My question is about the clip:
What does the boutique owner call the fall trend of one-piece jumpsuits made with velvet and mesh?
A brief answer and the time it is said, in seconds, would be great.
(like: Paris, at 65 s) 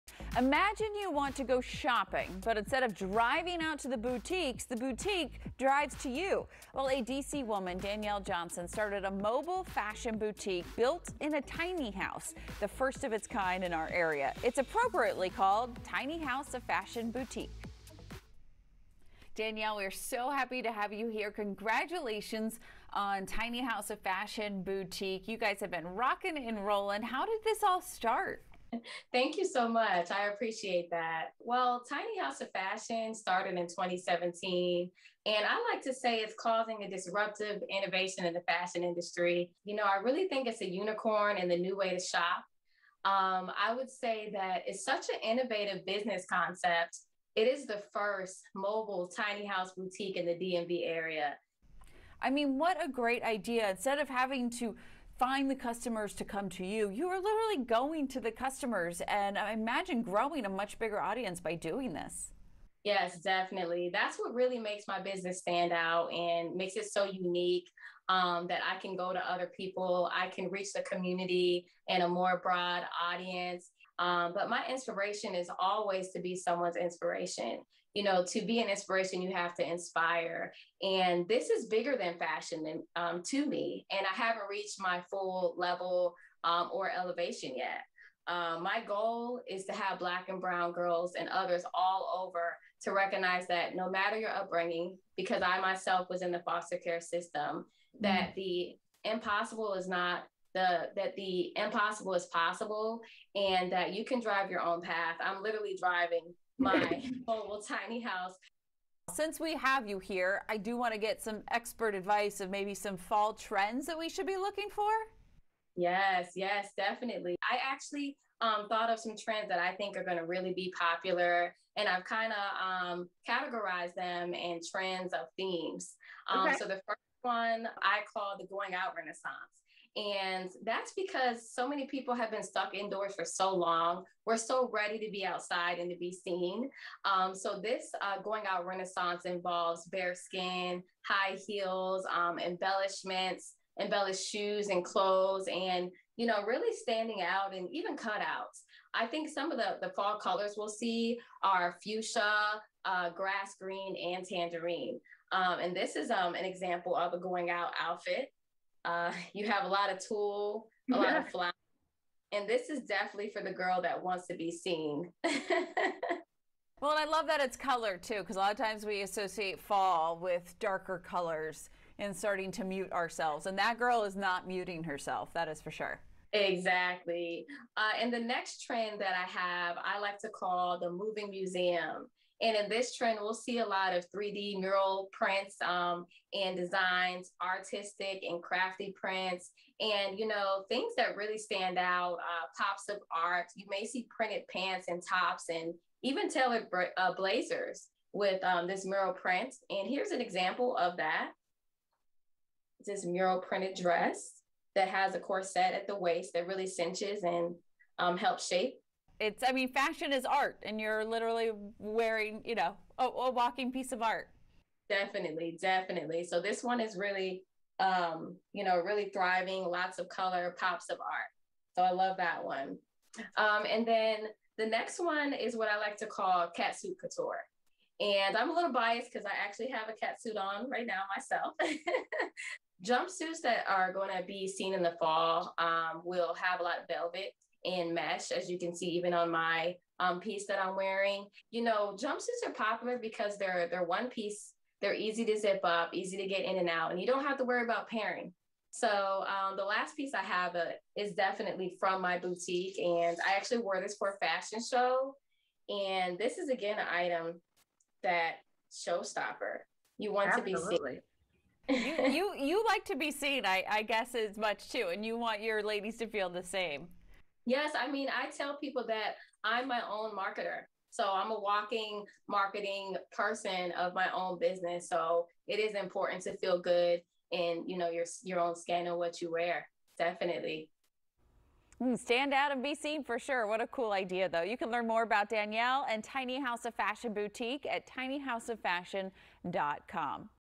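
Catsuit couture, at 226 s.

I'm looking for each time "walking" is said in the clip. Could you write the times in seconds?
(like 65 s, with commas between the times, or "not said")
213 s, 271 s.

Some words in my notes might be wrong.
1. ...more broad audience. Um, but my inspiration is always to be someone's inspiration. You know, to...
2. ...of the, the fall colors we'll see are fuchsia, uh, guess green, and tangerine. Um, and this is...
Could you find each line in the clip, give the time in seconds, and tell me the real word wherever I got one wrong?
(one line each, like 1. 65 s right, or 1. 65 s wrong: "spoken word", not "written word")
1. 72 s right
2. 149 s wrong: "grass", not "guess".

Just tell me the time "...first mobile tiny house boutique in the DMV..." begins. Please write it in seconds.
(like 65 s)
47 s.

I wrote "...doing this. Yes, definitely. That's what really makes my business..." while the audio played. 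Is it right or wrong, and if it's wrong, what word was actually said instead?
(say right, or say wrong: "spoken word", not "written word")
right.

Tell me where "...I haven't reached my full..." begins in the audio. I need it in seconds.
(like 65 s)
84 s.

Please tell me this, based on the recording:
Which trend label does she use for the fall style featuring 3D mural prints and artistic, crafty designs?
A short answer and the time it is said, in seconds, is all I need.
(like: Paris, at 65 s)
Moving museum, at 180 s.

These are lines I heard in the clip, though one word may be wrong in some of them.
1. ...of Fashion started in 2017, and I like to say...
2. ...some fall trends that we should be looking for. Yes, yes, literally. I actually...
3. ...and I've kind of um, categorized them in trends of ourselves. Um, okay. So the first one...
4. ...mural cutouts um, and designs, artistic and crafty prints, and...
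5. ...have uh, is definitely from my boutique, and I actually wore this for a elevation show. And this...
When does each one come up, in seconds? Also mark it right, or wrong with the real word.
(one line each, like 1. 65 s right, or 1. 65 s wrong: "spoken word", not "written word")
1. 32 s right
2. 112 s wrong: "definitely", not "literally"
3. 121 s wrong: "themes", not "ourselves"
4. 184 s wrong: "prints", not "cutouts"
5. 250 s wrong: "fashion", not "elevation".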